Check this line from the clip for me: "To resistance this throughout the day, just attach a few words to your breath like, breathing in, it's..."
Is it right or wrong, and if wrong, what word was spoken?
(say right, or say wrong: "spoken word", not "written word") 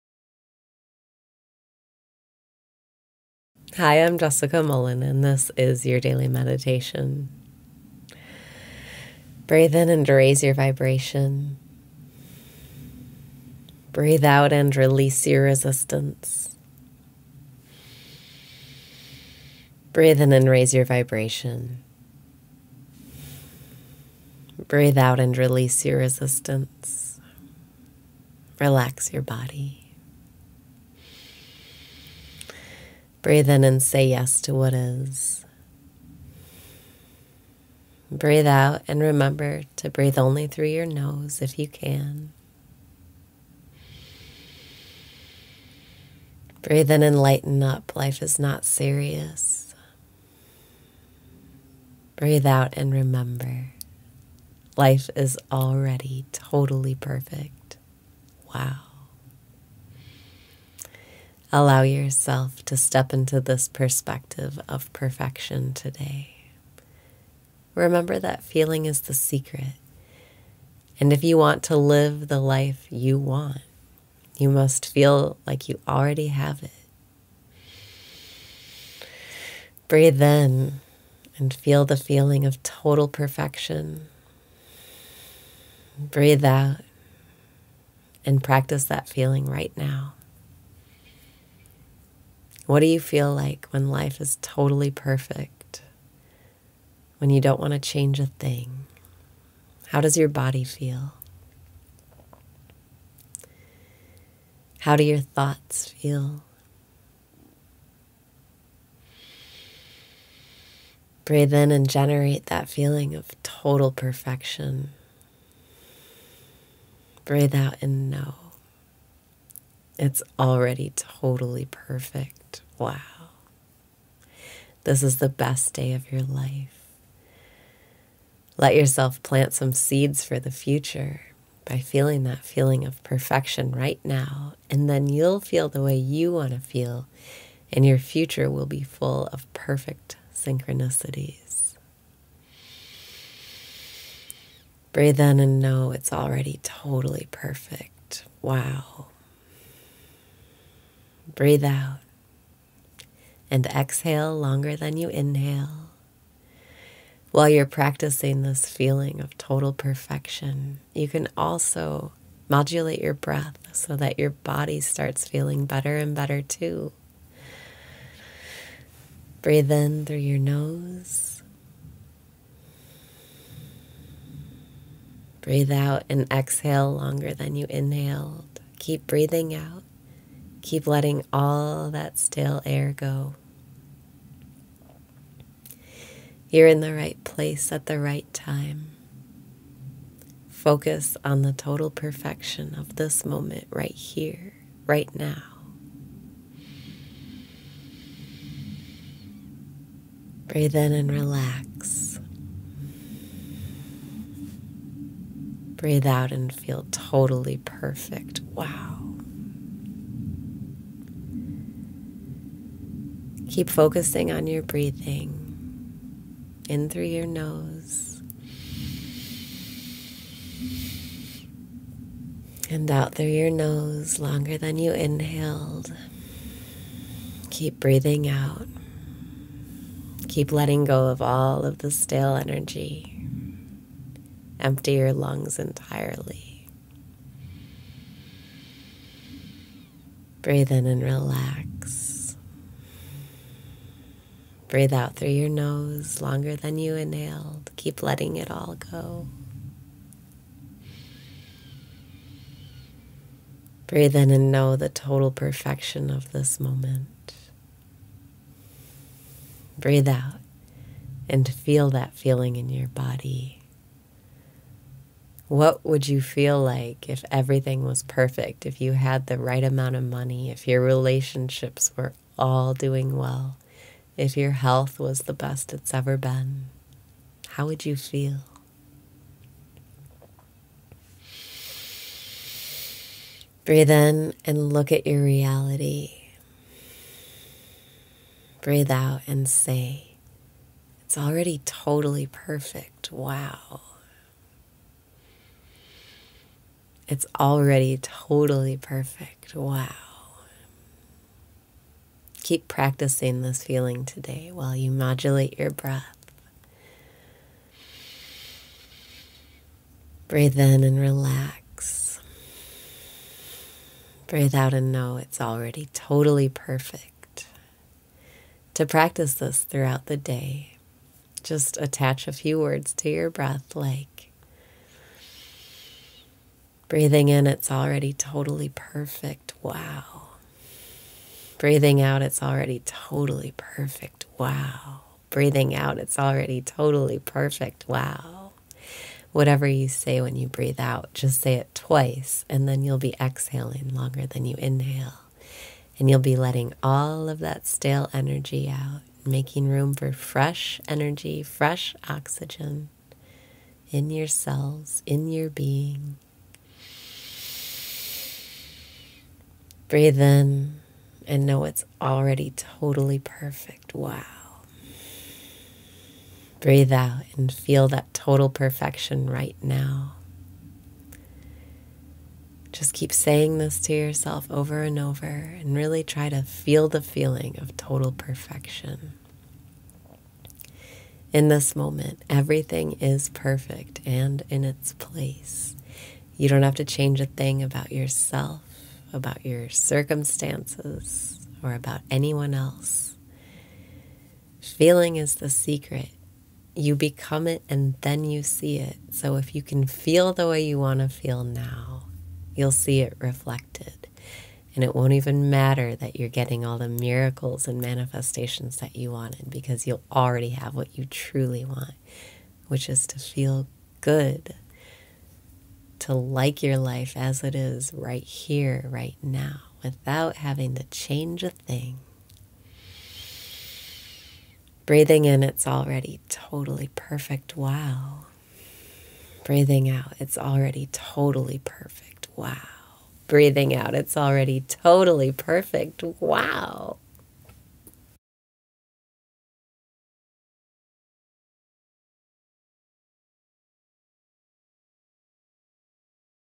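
wrong: "practice", not "resistance".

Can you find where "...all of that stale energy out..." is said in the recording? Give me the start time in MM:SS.
05:46.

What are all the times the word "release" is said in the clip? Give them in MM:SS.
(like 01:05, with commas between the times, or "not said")
00:14, 00:25.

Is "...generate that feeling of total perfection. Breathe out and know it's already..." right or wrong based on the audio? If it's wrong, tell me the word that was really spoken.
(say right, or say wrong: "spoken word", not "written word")
right.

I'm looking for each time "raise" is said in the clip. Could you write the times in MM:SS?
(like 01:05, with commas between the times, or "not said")
00:10, 00:20.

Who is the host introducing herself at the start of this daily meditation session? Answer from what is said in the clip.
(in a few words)
Jessica Mullen.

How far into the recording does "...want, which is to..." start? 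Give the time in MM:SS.
06:51.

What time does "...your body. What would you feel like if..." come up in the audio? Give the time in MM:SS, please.
04:22.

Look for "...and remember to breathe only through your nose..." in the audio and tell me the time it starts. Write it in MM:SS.
00:38.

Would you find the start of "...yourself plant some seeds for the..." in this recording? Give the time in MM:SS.
02:08.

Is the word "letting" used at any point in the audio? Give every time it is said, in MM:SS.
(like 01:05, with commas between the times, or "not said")
03:00, 03:50, 04:08, 05:46.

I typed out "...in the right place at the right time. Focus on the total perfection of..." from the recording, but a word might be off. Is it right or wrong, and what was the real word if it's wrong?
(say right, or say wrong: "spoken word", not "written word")
right.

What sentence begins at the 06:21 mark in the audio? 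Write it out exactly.
In this moment, everything is perfect and in its place.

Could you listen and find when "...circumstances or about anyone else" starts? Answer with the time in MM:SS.
06:29.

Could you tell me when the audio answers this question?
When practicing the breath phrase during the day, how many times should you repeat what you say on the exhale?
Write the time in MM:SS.
05:41.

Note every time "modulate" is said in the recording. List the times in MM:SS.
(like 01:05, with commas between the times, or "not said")
02:42, 05:04.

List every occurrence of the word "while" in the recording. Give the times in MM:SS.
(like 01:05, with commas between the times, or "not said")
02:37, 05:04.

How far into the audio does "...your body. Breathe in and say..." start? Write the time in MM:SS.
00:29.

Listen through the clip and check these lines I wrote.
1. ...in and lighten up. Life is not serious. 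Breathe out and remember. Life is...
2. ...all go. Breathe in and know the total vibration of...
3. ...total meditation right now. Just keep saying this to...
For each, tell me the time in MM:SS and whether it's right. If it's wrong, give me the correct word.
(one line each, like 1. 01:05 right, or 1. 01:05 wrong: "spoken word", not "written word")
1. 00:46 right
2. 04:08 wrong: "perfection", not "vibration"
3. 06:08 wrong: "perfection", not "meditation".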